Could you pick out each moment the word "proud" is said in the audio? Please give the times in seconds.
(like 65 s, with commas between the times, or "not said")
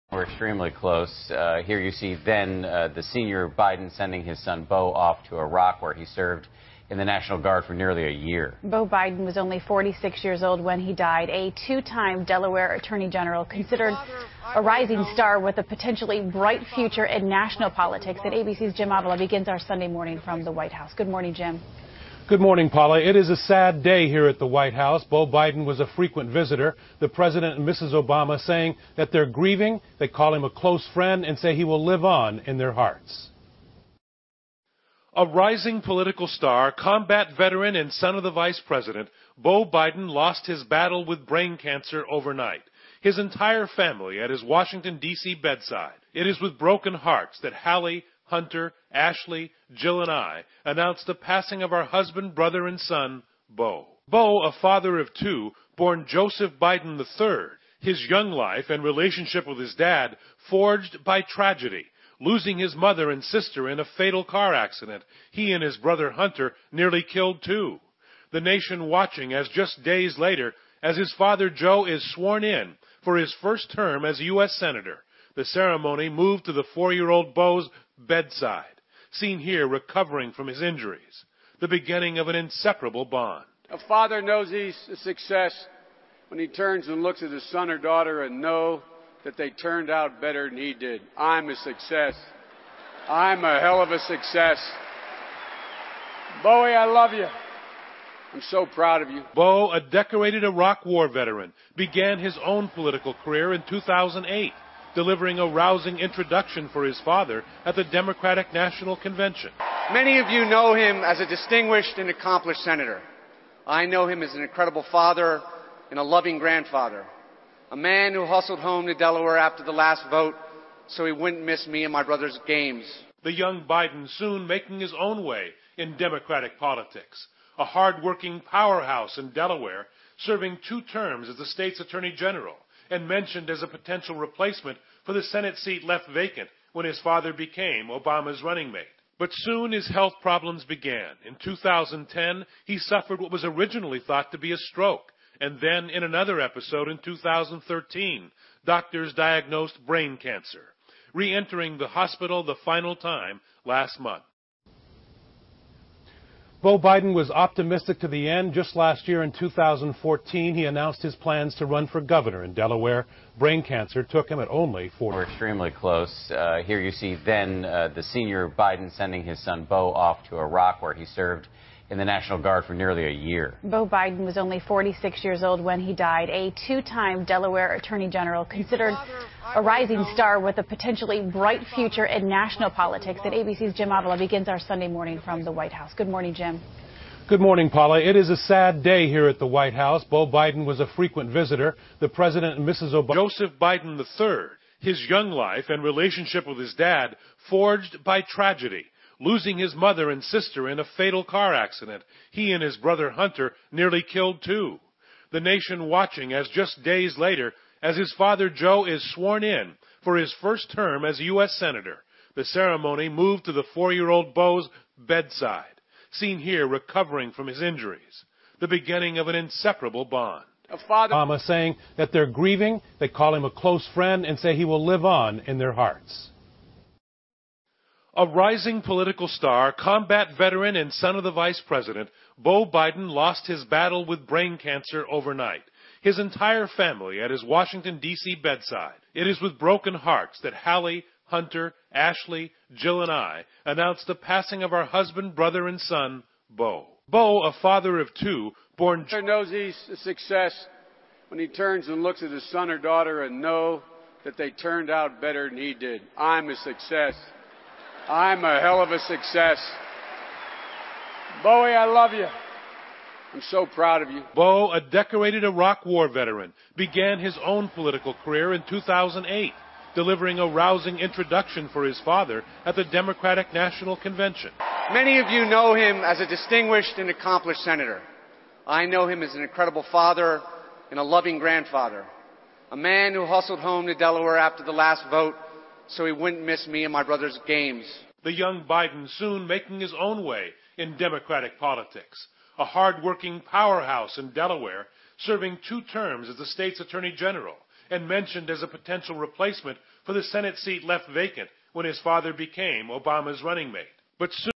98 s, 263 s.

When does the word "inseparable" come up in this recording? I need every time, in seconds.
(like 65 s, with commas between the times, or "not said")
82 s, 219 s.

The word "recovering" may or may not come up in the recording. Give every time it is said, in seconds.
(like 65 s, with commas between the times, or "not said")
79 s, 216 s.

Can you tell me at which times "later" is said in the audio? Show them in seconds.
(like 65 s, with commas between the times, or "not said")
70 s, 207 s.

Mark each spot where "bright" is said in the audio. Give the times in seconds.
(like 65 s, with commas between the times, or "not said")
16 s, 181 s.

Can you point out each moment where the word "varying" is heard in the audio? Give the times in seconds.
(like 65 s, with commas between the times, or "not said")
not said.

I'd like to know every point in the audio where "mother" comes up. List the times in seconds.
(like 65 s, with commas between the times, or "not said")
62 s, 199 s.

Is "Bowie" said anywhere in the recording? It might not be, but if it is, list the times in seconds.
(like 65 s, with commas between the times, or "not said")
96 s, 261 s.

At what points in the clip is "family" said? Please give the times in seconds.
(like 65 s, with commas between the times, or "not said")
43 s, 236 s.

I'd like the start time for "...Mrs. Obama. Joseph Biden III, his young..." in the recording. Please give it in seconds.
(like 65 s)
192 s.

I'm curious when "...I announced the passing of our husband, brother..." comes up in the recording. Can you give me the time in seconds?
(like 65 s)
50 s.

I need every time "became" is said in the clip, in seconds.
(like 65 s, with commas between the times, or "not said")
137 s, 302 s.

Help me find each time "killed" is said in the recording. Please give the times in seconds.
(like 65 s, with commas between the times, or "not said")
67 s, 204 s.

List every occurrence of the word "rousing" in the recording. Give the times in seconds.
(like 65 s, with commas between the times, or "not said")
105 s, 270 s.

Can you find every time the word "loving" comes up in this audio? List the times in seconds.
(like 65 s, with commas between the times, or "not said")
116 s, 281 s.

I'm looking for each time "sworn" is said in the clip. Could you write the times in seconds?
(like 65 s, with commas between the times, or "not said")
72 s, 209 s.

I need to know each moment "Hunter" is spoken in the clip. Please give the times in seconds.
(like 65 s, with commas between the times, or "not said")
48 s, 66 s, 203 s, 241 s.